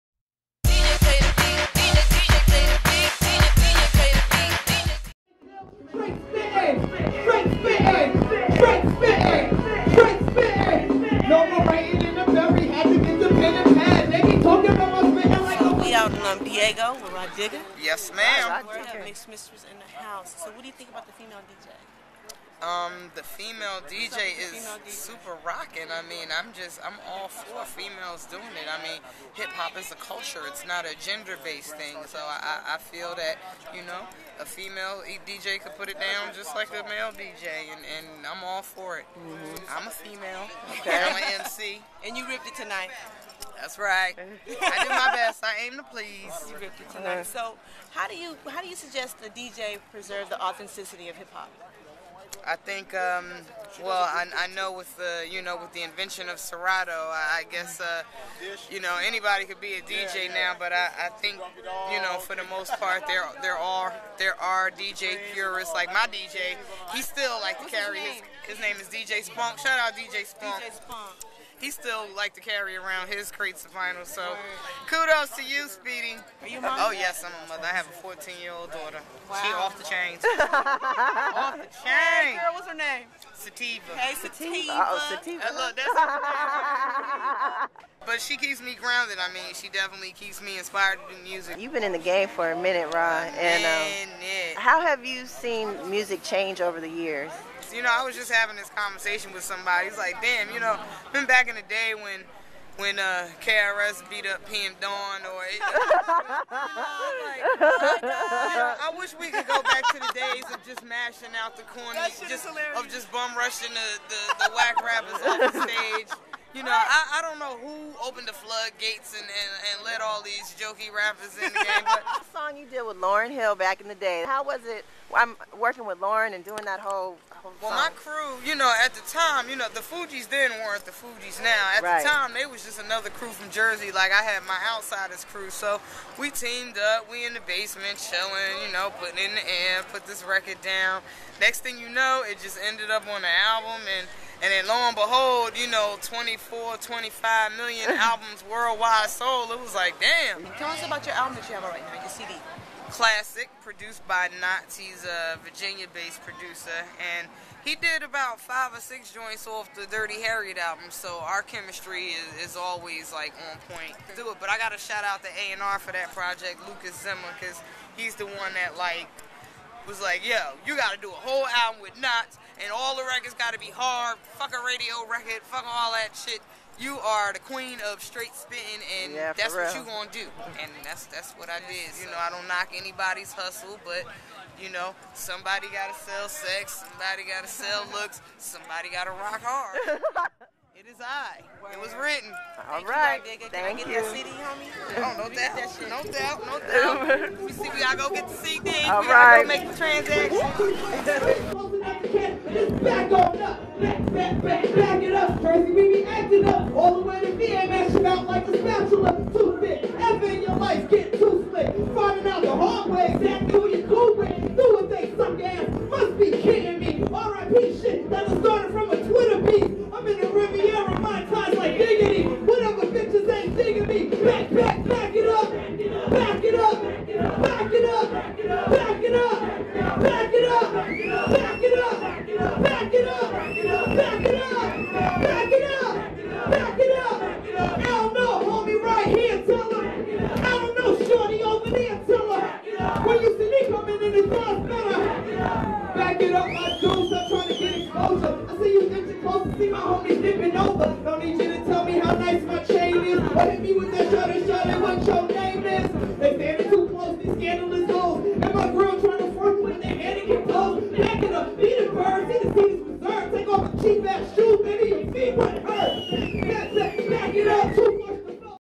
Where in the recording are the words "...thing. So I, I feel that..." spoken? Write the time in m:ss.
0:31.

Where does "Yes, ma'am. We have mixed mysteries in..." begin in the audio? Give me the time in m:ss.
0:17.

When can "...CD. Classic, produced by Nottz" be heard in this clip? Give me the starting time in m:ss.
2:32.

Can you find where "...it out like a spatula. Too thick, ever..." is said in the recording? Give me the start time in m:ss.
3:27.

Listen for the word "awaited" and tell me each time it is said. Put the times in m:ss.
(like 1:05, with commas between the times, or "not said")
not said.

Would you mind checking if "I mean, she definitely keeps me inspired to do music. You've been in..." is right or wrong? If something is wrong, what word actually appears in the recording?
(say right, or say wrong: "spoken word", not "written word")
right.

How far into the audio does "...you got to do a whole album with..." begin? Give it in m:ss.
2:50.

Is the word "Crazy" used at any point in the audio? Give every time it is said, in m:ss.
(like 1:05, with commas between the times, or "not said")
3:25.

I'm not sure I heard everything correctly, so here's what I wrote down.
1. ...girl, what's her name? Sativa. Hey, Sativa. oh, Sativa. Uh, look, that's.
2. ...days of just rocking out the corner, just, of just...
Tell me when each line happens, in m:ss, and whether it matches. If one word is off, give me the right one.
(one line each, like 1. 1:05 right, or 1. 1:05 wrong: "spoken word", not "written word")
1. 1:22 right
2. 1:50 wrong: "mashing", not "rocking".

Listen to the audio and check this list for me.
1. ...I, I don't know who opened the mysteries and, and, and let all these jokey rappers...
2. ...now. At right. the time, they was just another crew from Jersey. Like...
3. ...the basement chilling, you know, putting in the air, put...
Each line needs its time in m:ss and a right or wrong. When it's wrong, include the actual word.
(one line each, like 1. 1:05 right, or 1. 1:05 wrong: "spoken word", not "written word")
1. 1:56 wrong: "floodgates", not "mysteries"
2. 2:11 right
3. 2:17 right.